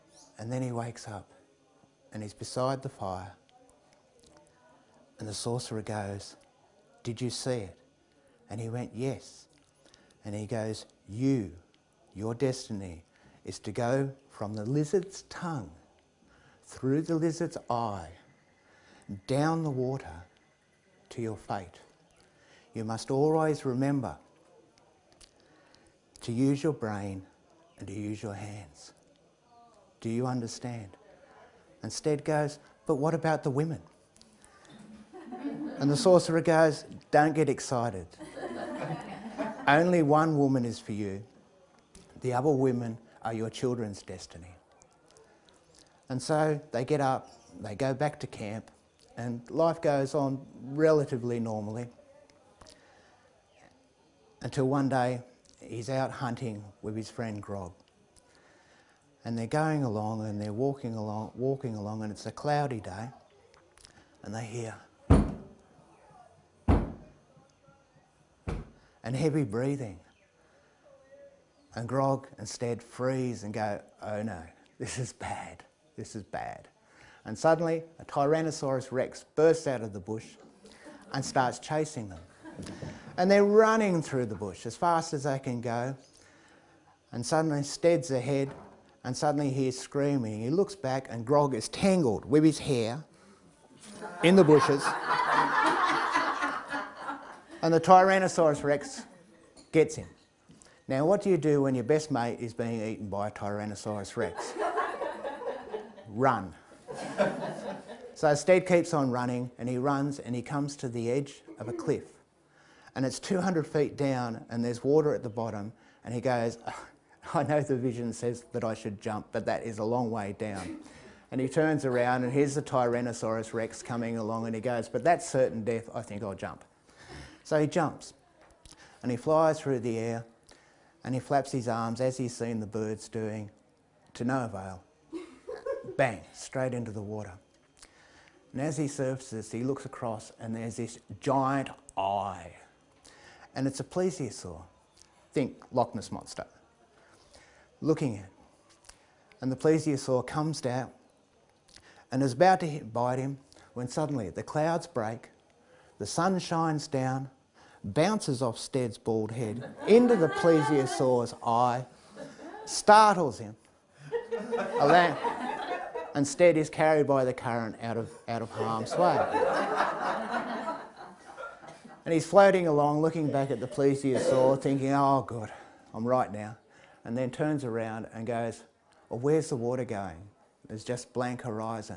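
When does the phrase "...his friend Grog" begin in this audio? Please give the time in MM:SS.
00:56.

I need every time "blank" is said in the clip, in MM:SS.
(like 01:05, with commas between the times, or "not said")
03:01.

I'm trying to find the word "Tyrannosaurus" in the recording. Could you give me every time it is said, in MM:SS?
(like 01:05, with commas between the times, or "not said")
01:18, 01:37, 01:43, 02:02.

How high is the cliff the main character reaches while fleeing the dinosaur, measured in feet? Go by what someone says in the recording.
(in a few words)
200 feet.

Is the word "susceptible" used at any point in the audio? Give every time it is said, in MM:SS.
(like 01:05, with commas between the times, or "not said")
not said.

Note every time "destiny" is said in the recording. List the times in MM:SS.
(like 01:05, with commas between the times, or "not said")
00:12, 00:44.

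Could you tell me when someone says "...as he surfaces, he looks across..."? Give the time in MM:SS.
02:18.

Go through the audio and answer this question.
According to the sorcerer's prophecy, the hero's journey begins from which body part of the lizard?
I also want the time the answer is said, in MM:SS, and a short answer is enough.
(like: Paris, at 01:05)
Tongue, at 00:15.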